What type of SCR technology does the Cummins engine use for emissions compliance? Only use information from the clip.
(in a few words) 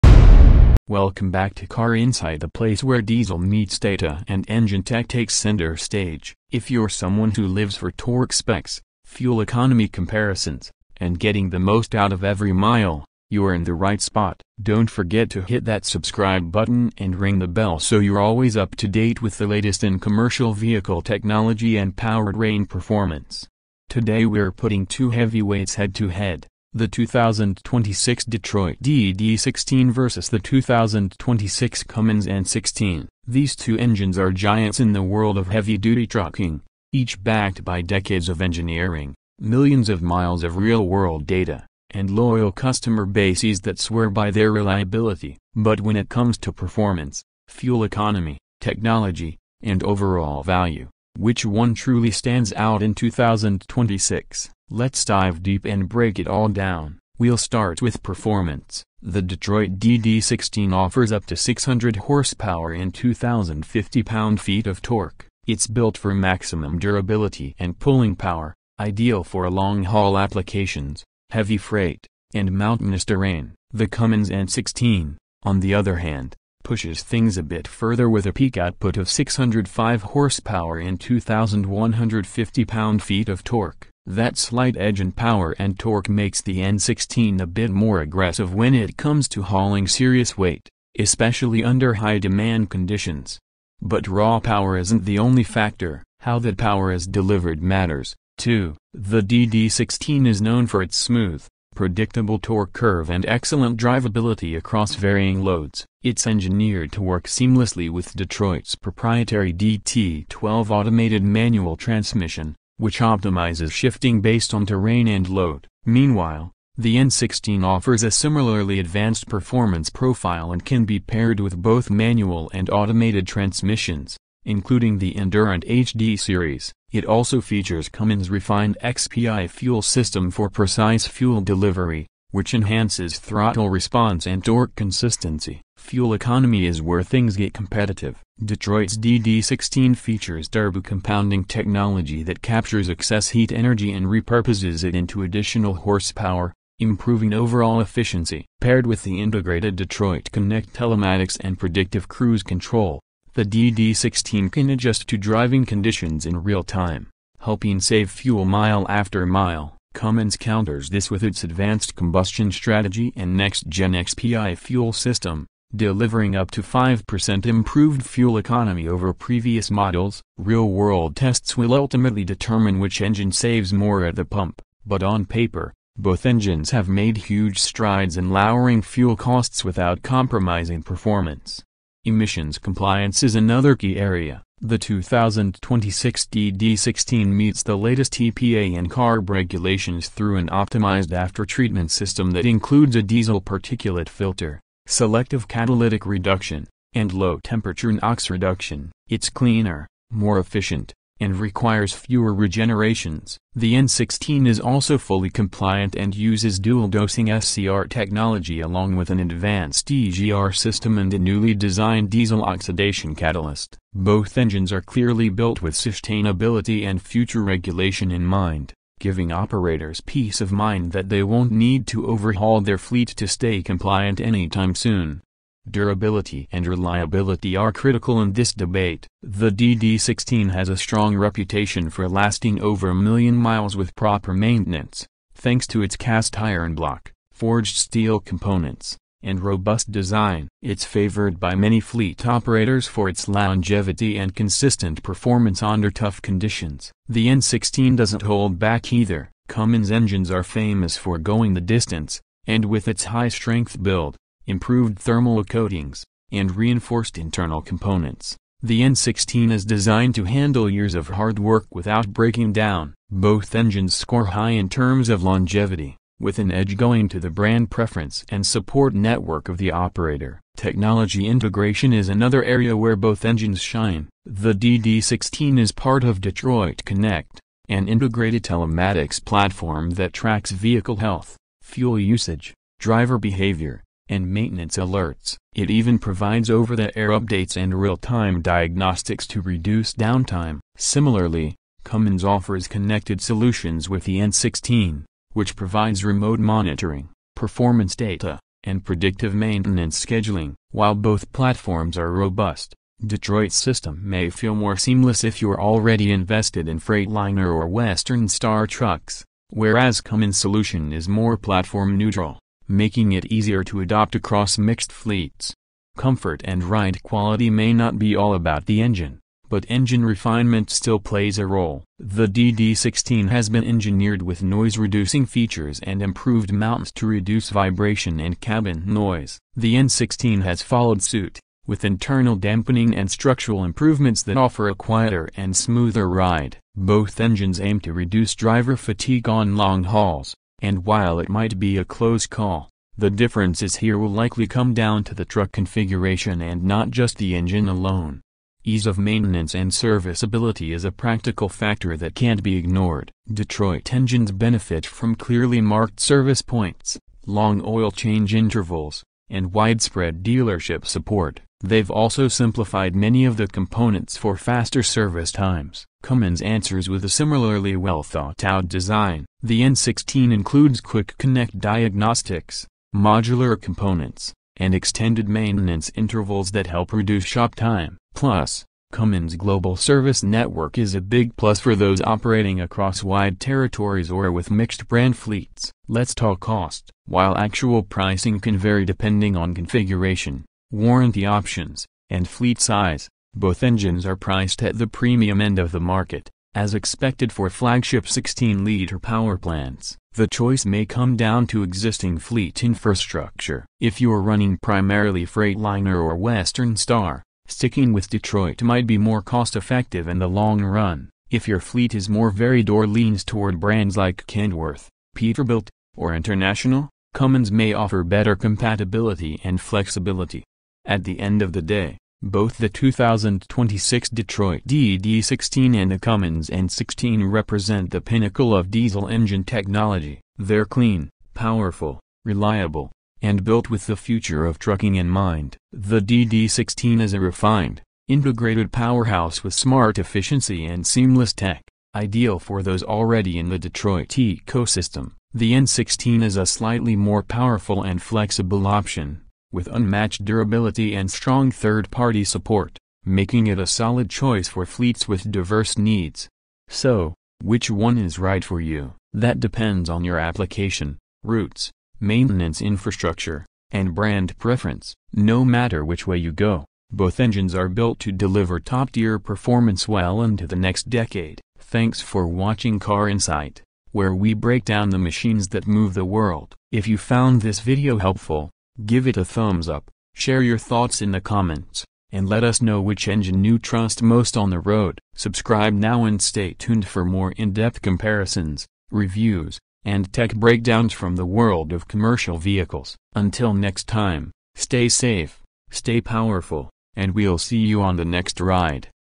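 Dual-dosing SCR.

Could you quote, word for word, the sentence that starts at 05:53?
Detroit engines benefit from clearly marked service points, long oil change intervals, and widespread dealership support.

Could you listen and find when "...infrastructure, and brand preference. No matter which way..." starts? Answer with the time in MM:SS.
07:42.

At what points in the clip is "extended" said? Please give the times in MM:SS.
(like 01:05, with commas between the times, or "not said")
06:14.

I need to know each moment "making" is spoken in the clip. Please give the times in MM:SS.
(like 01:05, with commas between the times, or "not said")
05:12, 07:33.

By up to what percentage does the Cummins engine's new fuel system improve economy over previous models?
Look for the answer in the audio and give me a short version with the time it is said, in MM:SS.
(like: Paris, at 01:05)
5%, at 02:46.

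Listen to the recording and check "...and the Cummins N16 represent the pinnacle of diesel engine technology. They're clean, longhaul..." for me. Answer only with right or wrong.
wrong.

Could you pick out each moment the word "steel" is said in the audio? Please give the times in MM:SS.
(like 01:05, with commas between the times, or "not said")
03:57.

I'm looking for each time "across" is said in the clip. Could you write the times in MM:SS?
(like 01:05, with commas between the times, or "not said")
01:44, 05:14, 06:22.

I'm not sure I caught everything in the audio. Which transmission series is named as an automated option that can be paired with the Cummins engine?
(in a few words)
Endurant HD.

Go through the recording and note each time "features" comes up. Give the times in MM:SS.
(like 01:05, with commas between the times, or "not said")
02:07, 02:19, 05:25.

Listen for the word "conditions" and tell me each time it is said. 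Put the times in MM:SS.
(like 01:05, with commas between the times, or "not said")
01:32, 02:35, 04:06.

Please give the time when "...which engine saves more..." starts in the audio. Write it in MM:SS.
02:52.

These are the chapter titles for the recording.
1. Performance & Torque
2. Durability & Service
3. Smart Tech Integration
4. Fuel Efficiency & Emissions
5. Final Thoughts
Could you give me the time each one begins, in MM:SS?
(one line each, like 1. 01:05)
1. 00:35
2. 03:10
3. 04:20
4. 02:00
5. 05:00.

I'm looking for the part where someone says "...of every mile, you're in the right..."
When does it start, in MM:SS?
00:12.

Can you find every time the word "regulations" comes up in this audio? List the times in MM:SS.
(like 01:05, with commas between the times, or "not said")
03:09, 03:37.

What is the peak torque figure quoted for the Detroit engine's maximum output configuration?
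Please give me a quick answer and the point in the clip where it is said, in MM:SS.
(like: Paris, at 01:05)
2,050 pound-feet, at 01:02.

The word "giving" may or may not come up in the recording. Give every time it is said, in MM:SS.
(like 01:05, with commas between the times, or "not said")
03:38.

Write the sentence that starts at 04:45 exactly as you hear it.
It even provides over-the-air updates and real-time diagnostics to reduce downtime.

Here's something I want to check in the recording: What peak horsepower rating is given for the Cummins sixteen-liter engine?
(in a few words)
605 horsepower.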